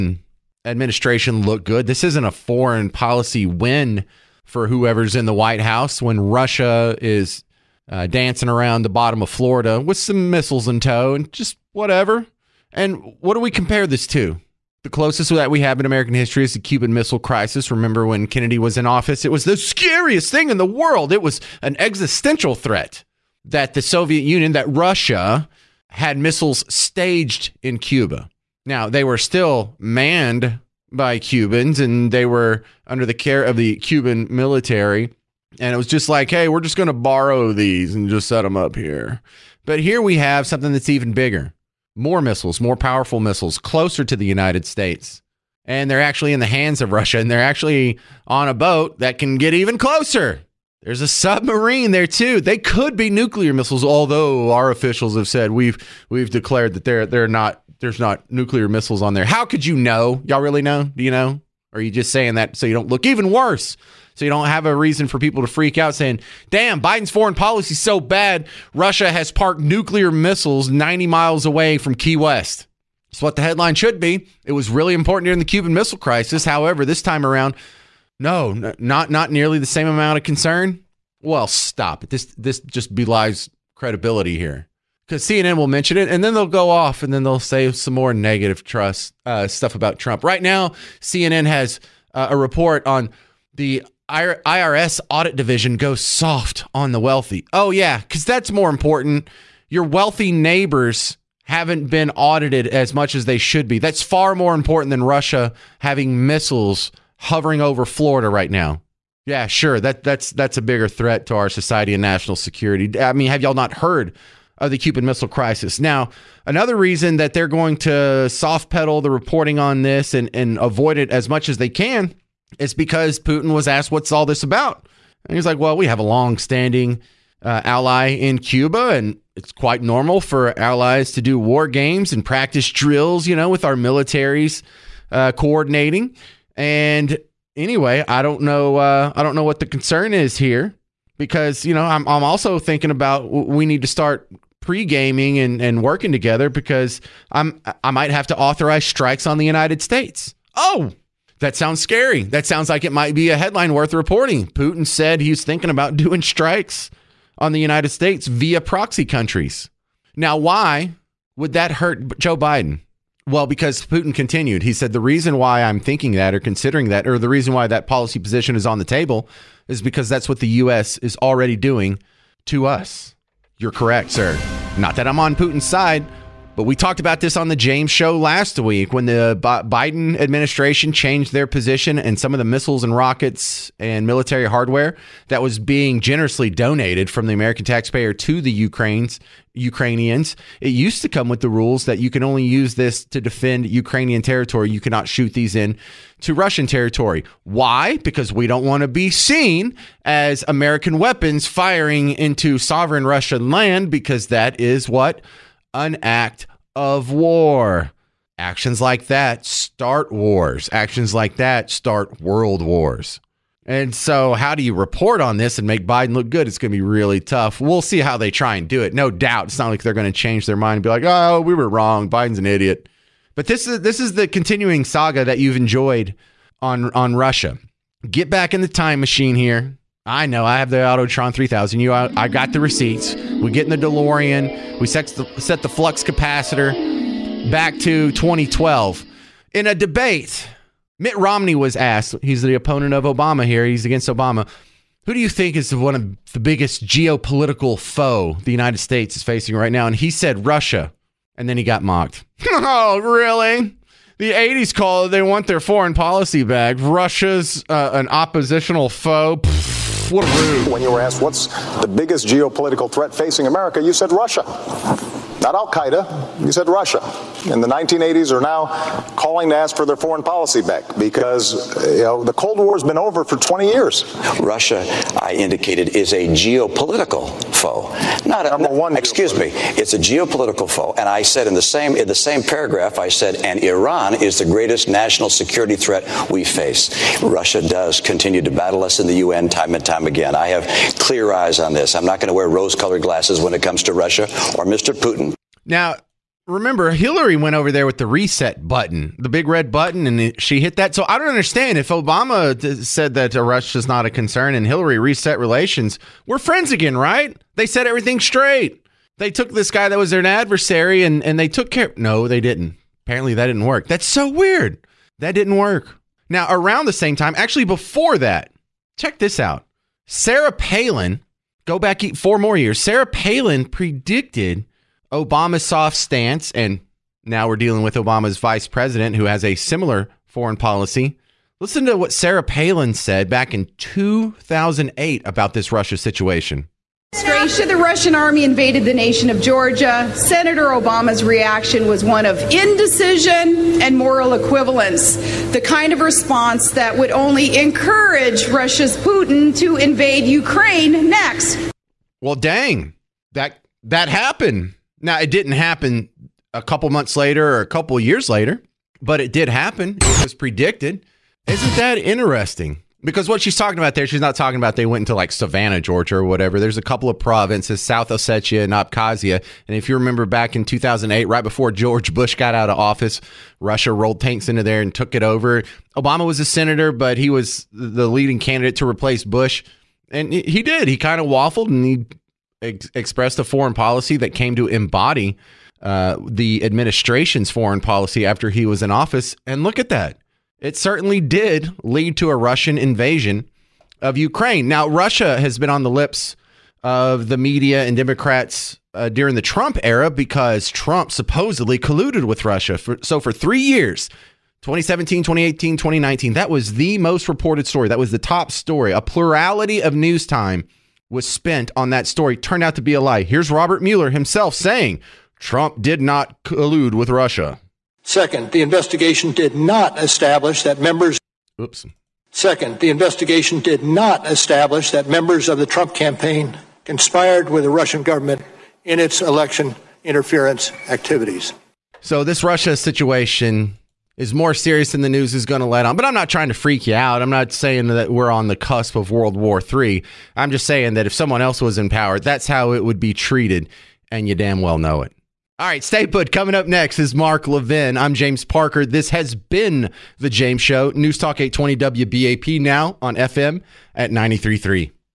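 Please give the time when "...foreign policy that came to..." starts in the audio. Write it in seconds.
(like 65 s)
383 s.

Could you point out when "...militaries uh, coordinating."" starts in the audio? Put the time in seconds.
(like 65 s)
133 s.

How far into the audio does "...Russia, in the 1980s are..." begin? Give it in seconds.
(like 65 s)
266 s.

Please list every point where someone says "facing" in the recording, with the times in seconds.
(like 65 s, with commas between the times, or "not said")
249 s, 263 s.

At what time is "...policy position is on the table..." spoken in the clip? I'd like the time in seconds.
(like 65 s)
167 s.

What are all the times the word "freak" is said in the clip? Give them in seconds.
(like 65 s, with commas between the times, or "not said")
65 s, 436 s.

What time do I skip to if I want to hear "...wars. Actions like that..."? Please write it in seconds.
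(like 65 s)
210 s.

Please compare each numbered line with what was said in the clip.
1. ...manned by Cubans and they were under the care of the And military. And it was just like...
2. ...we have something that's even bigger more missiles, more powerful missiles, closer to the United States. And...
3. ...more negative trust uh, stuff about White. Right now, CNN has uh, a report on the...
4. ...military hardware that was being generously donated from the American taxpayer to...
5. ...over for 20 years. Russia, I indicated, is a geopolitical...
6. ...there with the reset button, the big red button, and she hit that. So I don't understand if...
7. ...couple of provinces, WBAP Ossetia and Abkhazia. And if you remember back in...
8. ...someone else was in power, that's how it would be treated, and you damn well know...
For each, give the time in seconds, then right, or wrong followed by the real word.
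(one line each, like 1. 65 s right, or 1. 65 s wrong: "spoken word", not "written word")
1. 29 s wrong: "Cuban", not "And"
2. 40 s right
3. 87 s wrong: "Trump", not "White"
4. 184 s right
5. 272 s right
6. 297 s right
7. 366 s wrong: "South", not "WBAP"
8. 441 s right.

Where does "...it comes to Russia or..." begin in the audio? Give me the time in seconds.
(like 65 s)
293 s.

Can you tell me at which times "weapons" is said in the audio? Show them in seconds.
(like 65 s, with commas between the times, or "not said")
200 s.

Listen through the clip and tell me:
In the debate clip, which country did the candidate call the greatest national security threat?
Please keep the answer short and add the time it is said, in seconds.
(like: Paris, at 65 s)
Iran, at 283 s.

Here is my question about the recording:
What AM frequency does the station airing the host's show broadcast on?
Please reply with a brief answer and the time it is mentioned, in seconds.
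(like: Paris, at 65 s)
820, at 451 s.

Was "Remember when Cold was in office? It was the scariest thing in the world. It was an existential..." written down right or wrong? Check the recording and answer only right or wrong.
wrong.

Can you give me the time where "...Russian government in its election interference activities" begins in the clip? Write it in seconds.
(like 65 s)
427 s.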